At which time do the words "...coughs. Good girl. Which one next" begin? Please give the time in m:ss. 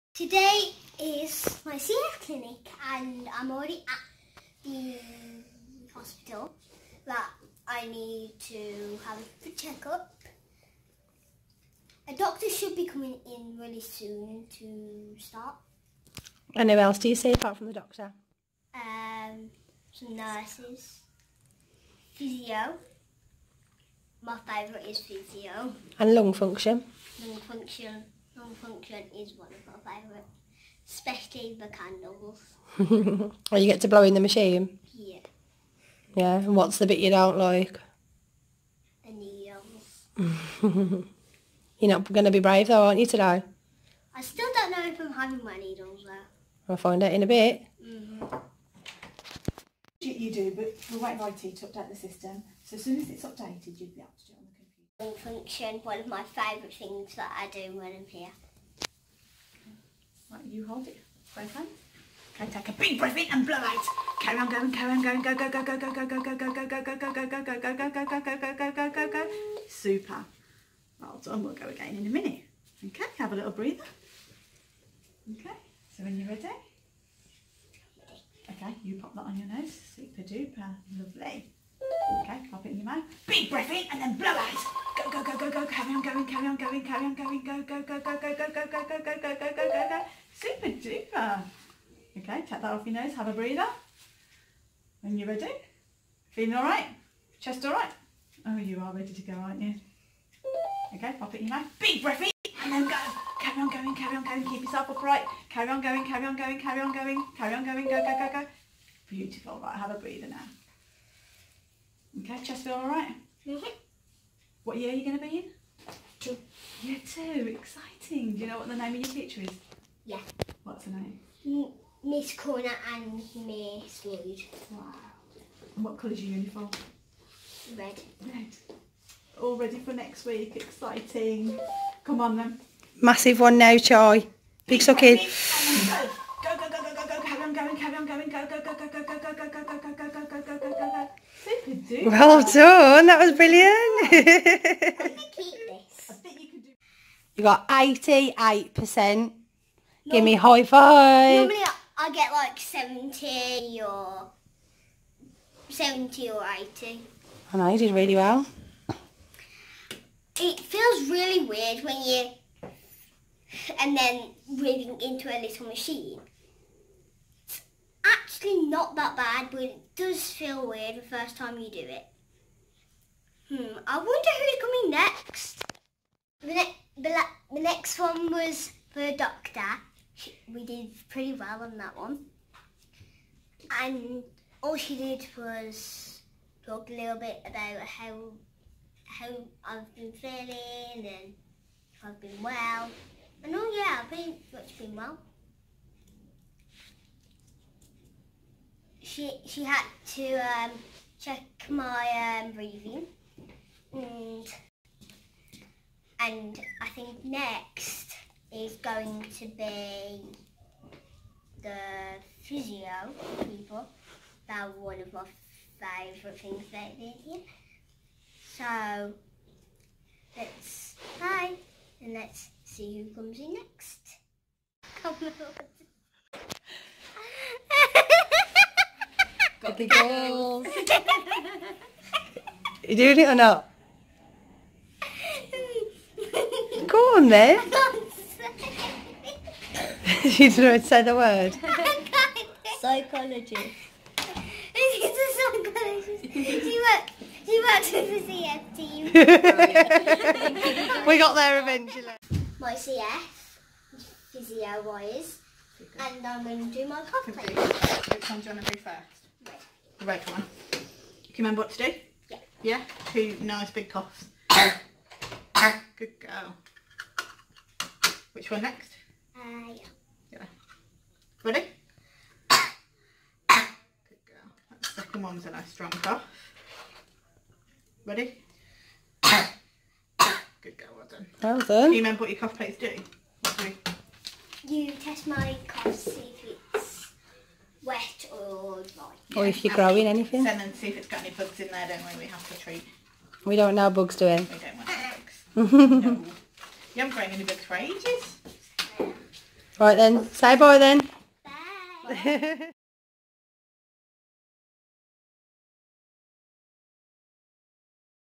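4:23.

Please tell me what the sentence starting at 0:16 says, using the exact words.
And who else do you see apart from the doctor?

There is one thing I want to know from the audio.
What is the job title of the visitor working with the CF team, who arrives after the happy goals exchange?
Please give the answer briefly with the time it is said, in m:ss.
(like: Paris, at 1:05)
Psychologist, at 4:05.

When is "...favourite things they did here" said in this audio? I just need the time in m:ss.
3:35.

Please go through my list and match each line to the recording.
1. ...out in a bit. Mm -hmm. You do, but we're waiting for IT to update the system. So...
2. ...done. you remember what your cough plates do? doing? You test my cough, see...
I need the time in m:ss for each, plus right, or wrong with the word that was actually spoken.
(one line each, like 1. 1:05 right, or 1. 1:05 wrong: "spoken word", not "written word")
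1. 0:47 right
2. 4:41 right.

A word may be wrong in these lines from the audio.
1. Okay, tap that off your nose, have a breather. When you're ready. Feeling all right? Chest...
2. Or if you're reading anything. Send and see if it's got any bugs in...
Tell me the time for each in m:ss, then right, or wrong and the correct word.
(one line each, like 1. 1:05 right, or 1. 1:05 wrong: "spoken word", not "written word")
1. 1:32 right
2. 4:49 wrong: "growing", not "reading".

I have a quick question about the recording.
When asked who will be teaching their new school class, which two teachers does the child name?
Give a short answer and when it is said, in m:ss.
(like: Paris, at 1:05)
Miss Corner and Miss Wood, at 2:02.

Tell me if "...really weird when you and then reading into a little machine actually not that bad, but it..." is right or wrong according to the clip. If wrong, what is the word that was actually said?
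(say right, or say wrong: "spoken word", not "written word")
right.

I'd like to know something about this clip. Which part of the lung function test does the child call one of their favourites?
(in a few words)
The candles.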